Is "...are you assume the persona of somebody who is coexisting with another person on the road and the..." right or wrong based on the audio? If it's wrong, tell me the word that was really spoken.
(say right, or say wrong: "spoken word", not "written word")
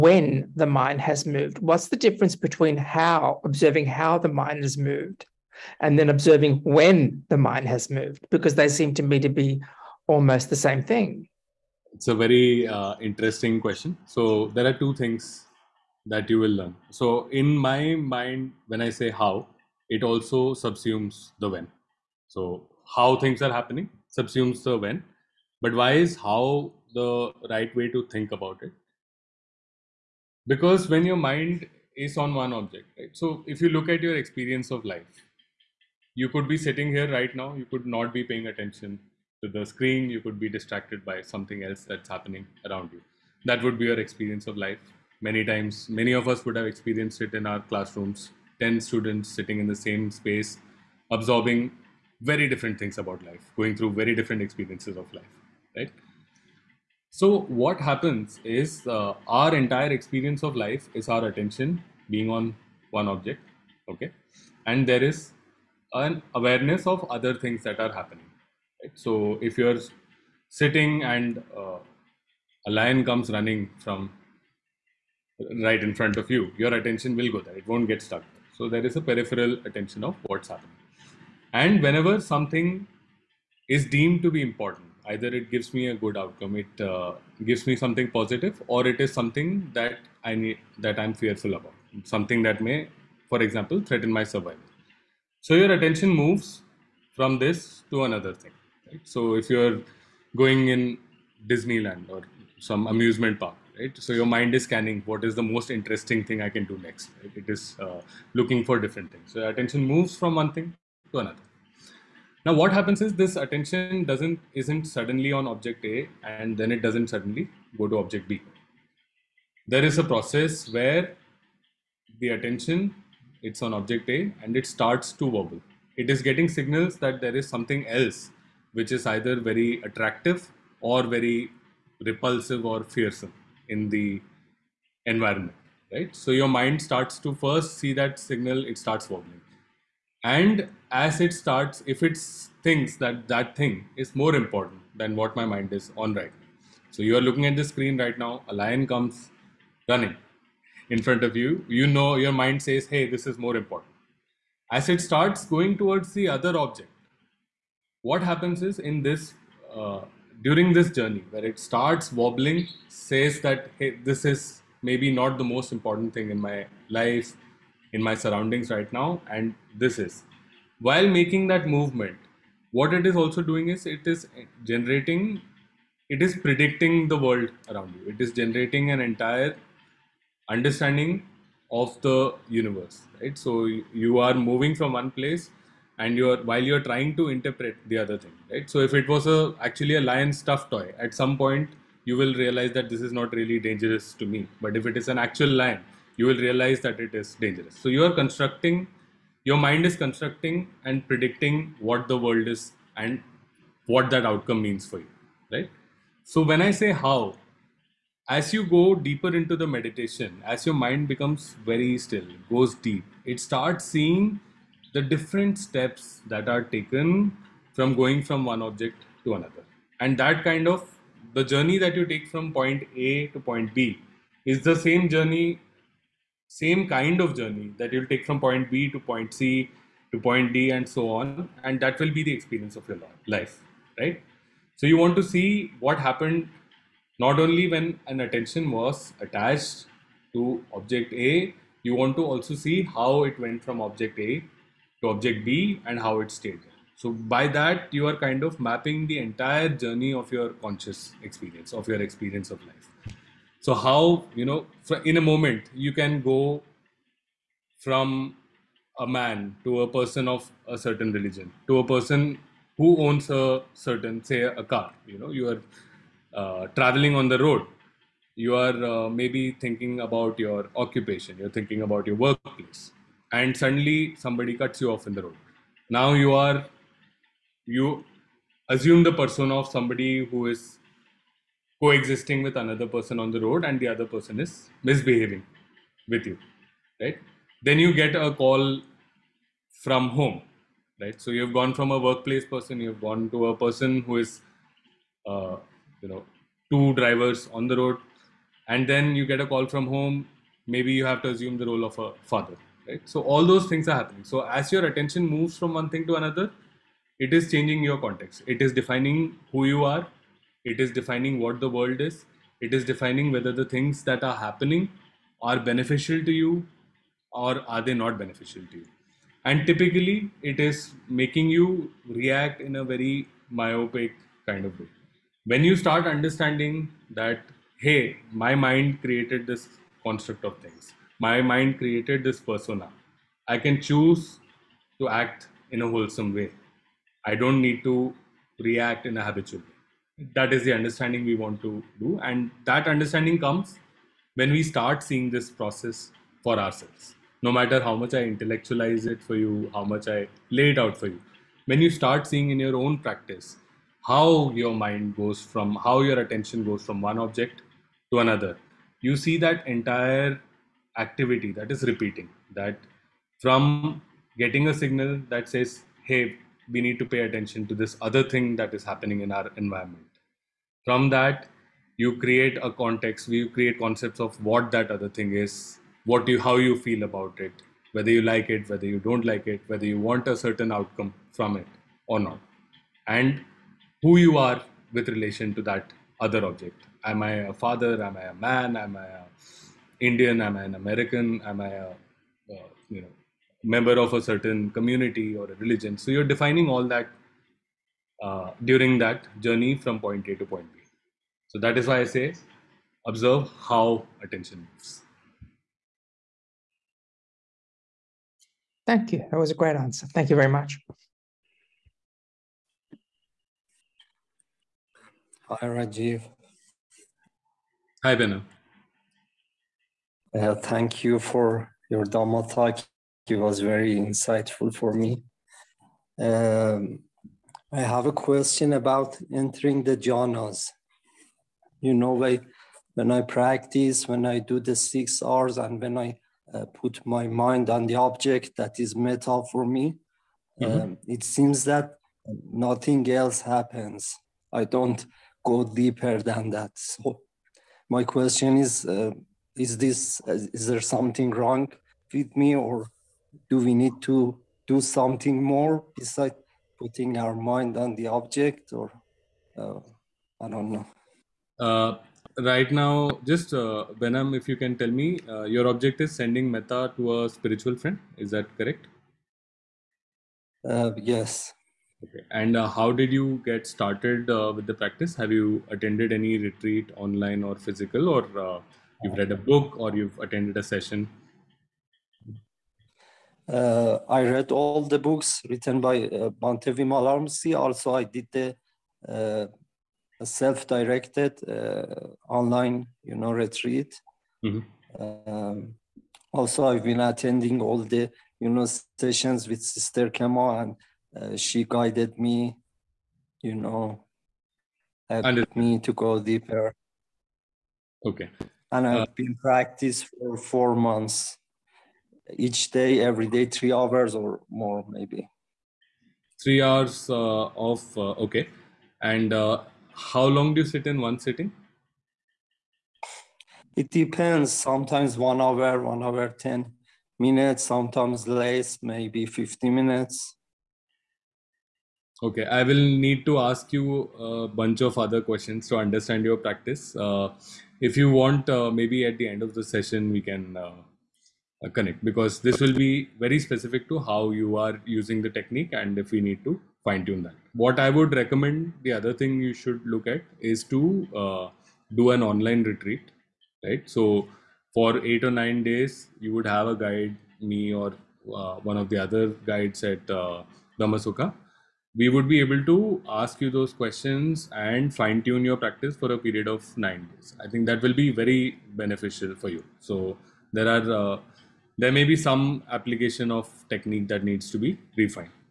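right.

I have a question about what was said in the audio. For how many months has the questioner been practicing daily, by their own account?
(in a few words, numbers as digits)
4.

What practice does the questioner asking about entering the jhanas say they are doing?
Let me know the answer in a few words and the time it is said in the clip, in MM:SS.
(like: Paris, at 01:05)
six Rs, at 07:14.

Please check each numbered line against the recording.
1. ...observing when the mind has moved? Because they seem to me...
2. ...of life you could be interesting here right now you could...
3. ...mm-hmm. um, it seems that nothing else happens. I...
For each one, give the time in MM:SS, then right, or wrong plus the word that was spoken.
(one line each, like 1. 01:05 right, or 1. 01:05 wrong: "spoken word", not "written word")
1. 00:06 right
2. 00:34 wrong: "sitting", not "interesting"
3. 07:20 right.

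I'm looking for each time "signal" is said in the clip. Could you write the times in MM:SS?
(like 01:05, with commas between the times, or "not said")
02:06, 02:18, 06:04.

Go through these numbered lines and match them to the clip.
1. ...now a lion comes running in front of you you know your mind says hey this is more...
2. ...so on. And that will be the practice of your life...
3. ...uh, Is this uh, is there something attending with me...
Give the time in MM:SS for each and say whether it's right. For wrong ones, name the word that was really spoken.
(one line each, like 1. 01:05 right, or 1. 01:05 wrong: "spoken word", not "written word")
1. 02:28 right
2. 03:50 wrong: "experience", not "practice"
3. 07:28 wrong: "wrong", not "attending".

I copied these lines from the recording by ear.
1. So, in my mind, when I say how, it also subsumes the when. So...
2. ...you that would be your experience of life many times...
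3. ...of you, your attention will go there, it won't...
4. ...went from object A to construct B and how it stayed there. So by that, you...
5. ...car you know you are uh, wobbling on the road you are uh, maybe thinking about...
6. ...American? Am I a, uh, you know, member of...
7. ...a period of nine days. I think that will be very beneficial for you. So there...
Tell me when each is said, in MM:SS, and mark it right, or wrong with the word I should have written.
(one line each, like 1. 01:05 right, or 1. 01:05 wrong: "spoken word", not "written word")
1. 00:16 right
2. 00:42 right
3. 01:16 right
4. 04:03 wrong: "object", not "construct"
5. 04:24 wrong: "traveling", not "wobbling"
6. 06:30 right
7. 09:26 right.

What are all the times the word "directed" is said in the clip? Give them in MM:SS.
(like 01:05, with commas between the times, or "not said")
08:10.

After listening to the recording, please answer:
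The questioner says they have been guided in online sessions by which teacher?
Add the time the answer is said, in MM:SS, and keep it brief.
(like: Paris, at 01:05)
Sister Khema, at 08:19.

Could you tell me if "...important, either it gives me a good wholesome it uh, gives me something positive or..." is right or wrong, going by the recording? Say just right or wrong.
wrong.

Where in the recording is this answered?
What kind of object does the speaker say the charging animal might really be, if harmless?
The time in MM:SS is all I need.
03:10.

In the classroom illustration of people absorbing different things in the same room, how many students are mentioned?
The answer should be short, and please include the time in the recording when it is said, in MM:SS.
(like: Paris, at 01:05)
10, at 00:48.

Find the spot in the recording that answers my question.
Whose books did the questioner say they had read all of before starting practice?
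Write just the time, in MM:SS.
08:06.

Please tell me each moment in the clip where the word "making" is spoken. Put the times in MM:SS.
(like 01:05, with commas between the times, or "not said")
02:51, 05:21.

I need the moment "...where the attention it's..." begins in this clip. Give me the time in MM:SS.
02:00.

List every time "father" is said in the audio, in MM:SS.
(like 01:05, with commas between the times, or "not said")
05:02, 06:27.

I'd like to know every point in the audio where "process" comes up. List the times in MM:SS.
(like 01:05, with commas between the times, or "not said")
02:00, 05:45.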